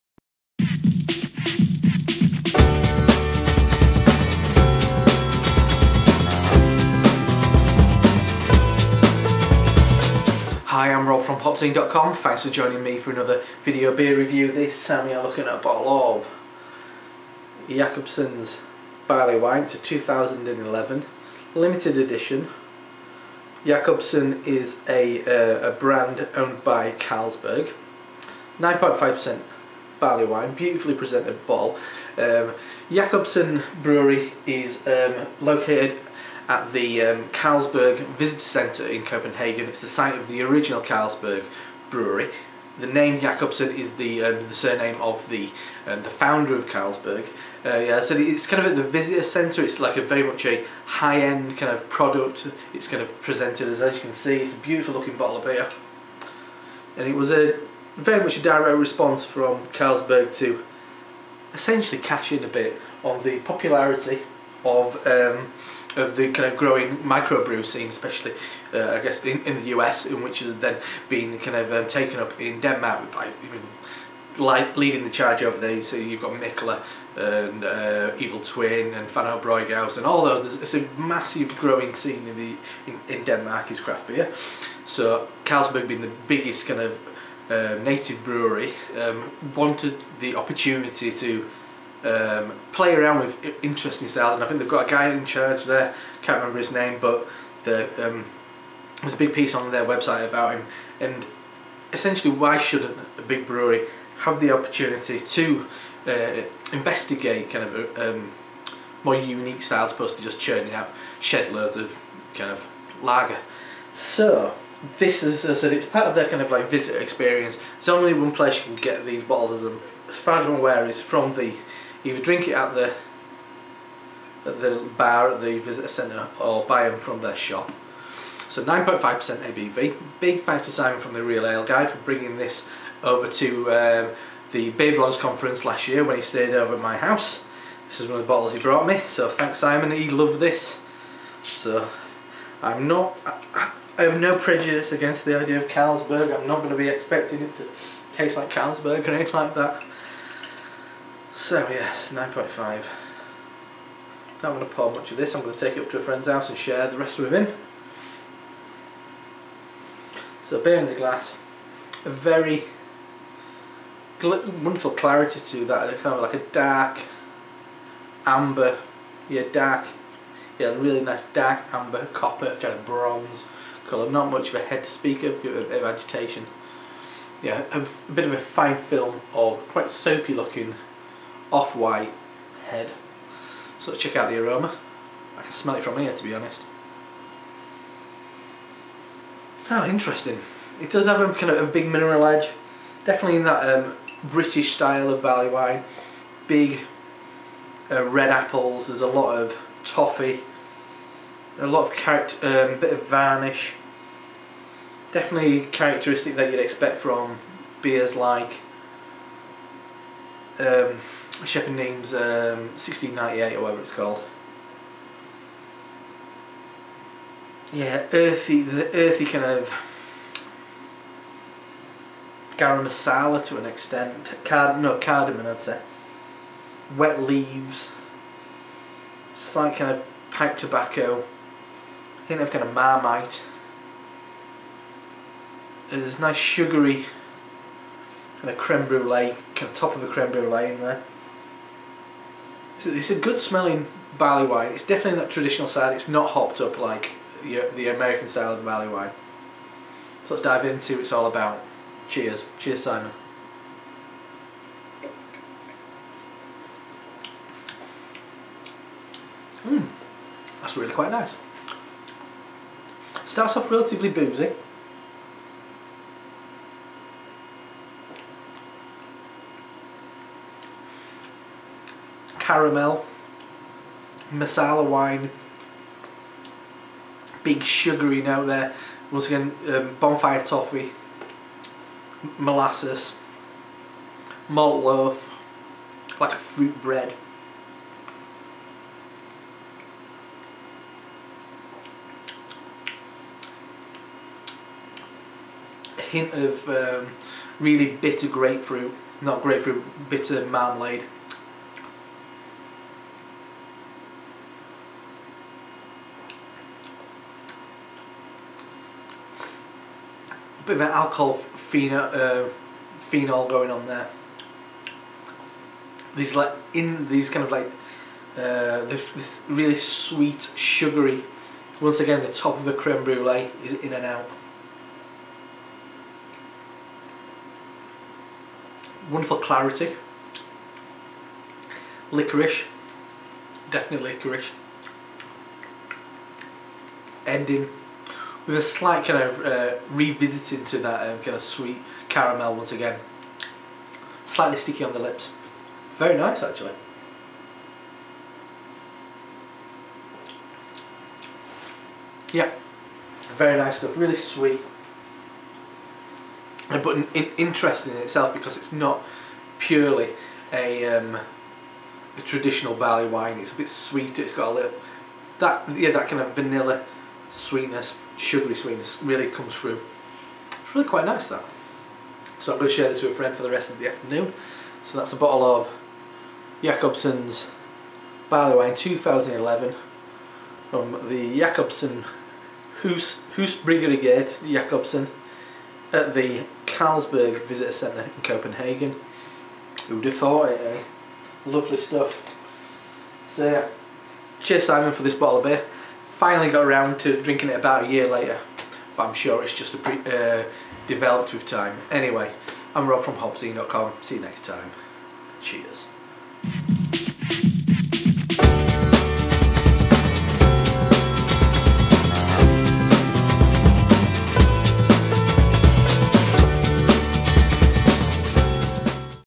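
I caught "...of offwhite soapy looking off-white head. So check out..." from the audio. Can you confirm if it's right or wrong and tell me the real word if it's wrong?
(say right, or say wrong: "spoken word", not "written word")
wrong: "quite", not "offwhite".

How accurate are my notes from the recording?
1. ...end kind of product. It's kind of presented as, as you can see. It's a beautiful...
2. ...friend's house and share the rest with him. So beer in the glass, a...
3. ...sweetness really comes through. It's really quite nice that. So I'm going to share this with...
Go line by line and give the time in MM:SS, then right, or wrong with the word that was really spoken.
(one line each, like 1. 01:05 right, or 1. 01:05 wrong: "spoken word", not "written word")
1. 00:51 right
2. 02:36 right
3. 06:08 right.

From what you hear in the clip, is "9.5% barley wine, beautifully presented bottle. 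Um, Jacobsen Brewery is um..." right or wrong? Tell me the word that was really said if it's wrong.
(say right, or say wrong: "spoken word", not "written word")
right.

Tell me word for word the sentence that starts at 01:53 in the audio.
So this is, as I said, it's part of their kind of like visitor experience.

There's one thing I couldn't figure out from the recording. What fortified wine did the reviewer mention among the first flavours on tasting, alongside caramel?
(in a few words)
Marsala.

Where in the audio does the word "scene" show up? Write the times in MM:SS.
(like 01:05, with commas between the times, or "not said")
01:07, 01:21.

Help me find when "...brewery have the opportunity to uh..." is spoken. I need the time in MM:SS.
01:43.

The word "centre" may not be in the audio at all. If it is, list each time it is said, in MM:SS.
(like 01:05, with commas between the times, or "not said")
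00:38, 00:49, 02:05, 06:27.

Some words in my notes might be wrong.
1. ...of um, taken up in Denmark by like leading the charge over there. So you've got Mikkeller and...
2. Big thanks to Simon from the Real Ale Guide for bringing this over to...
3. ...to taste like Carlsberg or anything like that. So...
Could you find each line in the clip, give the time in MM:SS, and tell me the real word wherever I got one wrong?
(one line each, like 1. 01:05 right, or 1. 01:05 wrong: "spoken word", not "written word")
1. 01:11 right
2. 02:10 right
3. 02:27 right.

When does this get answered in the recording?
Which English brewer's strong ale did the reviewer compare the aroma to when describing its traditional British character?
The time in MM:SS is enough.
03:31.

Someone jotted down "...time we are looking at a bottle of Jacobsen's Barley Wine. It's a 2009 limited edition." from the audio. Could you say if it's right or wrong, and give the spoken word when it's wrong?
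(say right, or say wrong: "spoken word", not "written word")
wrong: "2011", not "2009".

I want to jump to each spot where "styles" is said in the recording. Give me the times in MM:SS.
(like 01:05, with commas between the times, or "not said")
01:34, 01:49, 03:14, 04:08.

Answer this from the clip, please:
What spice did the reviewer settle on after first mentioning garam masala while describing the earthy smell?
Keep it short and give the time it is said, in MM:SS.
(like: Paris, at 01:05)
Cardamom, at 03:44.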